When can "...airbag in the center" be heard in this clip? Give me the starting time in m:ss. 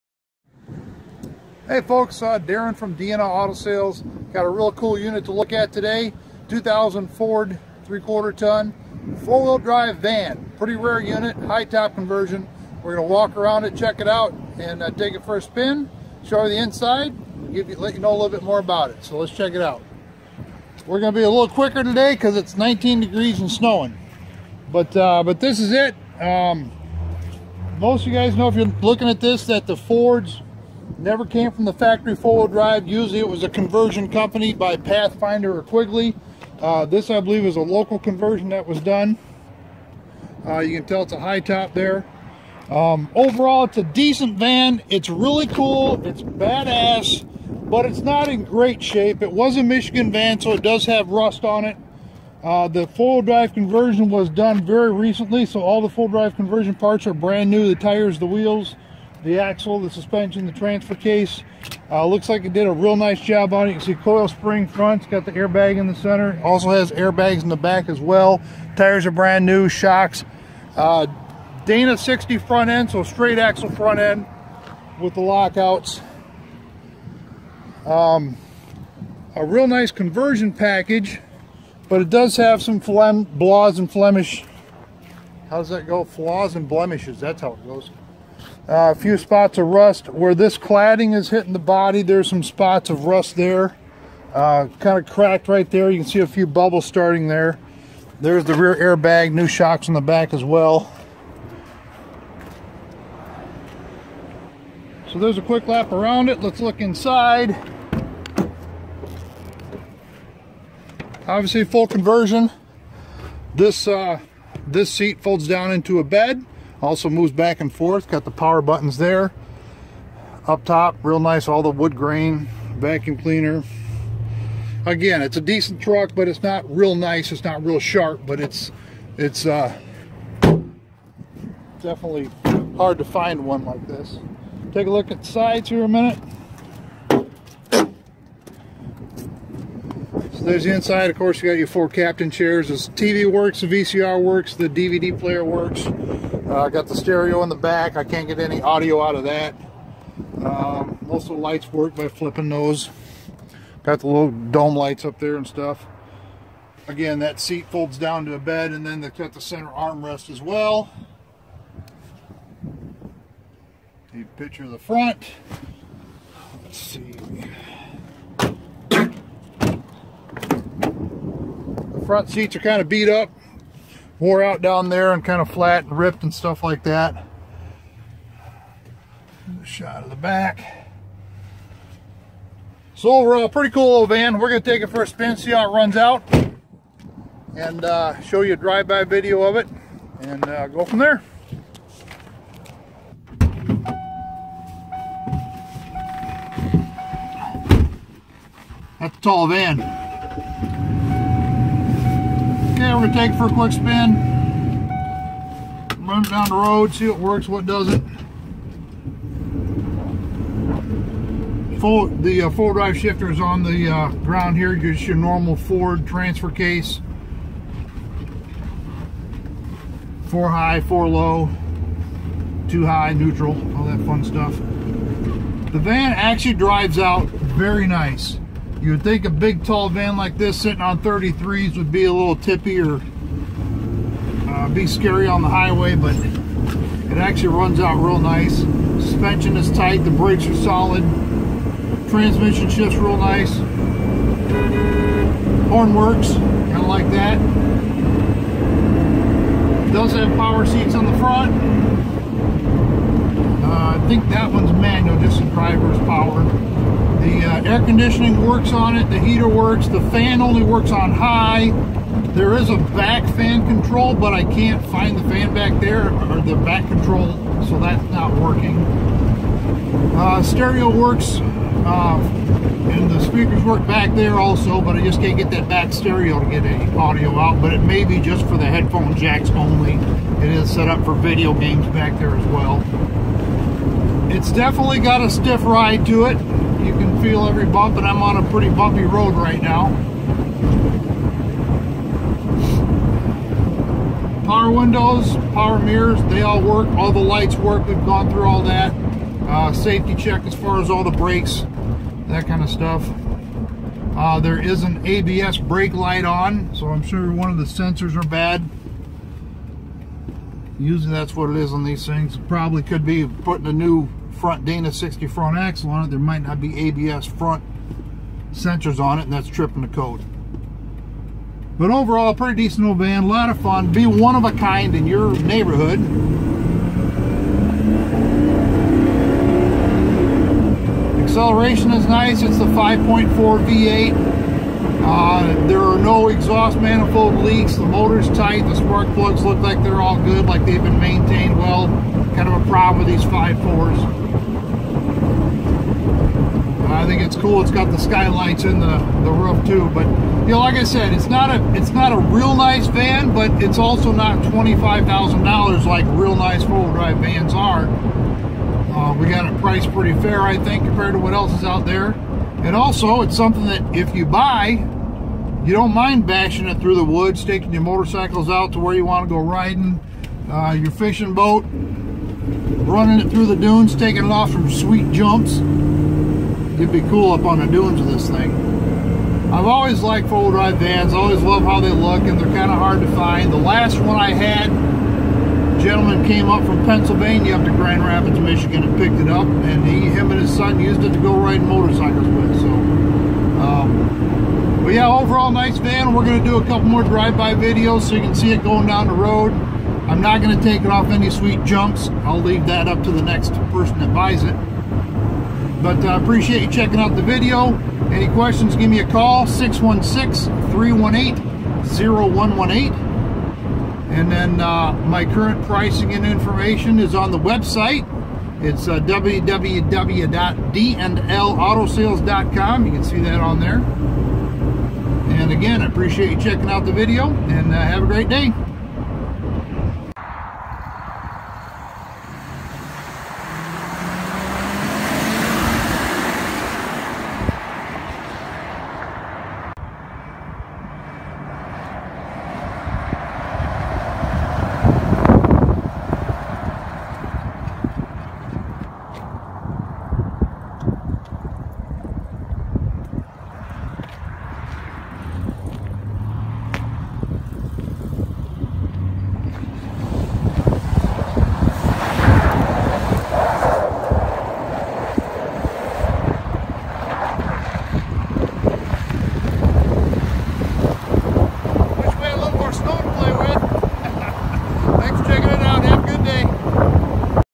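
1:05.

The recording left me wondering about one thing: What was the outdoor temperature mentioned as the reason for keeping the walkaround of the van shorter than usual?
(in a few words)
19 degrees.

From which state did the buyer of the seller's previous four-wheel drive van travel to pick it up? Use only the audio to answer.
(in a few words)
Pennsylvania.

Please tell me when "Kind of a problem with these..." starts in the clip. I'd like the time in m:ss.
5:42.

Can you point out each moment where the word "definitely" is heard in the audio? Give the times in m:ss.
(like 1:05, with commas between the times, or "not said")
2:11, 4:44.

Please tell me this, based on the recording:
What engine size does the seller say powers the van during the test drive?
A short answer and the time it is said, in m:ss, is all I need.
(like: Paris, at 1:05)
5.4 V8, at 5:32.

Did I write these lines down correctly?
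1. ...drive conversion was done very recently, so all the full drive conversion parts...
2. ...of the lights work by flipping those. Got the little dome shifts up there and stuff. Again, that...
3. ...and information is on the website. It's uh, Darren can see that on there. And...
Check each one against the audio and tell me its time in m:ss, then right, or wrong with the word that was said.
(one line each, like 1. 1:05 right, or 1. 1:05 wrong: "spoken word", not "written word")
1. 0:53 right
2. 2:31 wrong: "lights", not "shifts"
3. 6:56 wrong: "You", not "Darren".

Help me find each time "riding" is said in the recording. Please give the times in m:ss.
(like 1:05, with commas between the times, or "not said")
6:09, 6:31.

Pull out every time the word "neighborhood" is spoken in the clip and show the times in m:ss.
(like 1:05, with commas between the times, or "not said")
5:25.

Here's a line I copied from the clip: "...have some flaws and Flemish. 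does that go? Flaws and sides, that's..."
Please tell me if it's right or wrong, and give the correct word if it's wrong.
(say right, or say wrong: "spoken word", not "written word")
wrong: "blemishes", not "sides".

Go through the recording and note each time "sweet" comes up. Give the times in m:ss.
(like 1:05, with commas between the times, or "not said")
6:14, 6:41.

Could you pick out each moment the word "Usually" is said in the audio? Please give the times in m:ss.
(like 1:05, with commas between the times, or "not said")
0:32, 5:10.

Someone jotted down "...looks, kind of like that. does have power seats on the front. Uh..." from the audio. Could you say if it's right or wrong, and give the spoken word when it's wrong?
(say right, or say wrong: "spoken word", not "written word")
wrong: "works", not "looks".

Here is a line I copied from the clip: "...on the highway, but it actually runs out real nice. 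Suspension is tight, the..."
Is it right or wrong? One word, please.
right.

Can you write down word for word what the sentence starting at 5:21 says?
But overall, pretty decent old van, a lot of fun.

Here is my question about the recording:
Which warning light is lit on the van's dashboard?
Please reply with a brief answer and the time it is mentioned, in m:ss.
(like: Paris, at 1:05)
ABS brake light, at 5:05.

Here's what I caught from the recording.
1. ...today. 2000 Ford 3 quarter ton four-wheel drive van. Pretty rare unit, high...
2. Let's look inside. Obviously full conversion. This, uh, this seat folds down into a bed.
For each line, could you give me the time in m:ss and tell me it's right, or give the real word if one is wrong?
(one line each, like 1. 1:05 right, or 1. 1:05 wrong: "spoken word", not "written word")
1. 0:05 right
2. 1:46 right.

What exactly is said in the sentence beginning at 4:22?
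There is a back fan control, but I can't find the fan back there, or the back control, so that's not working.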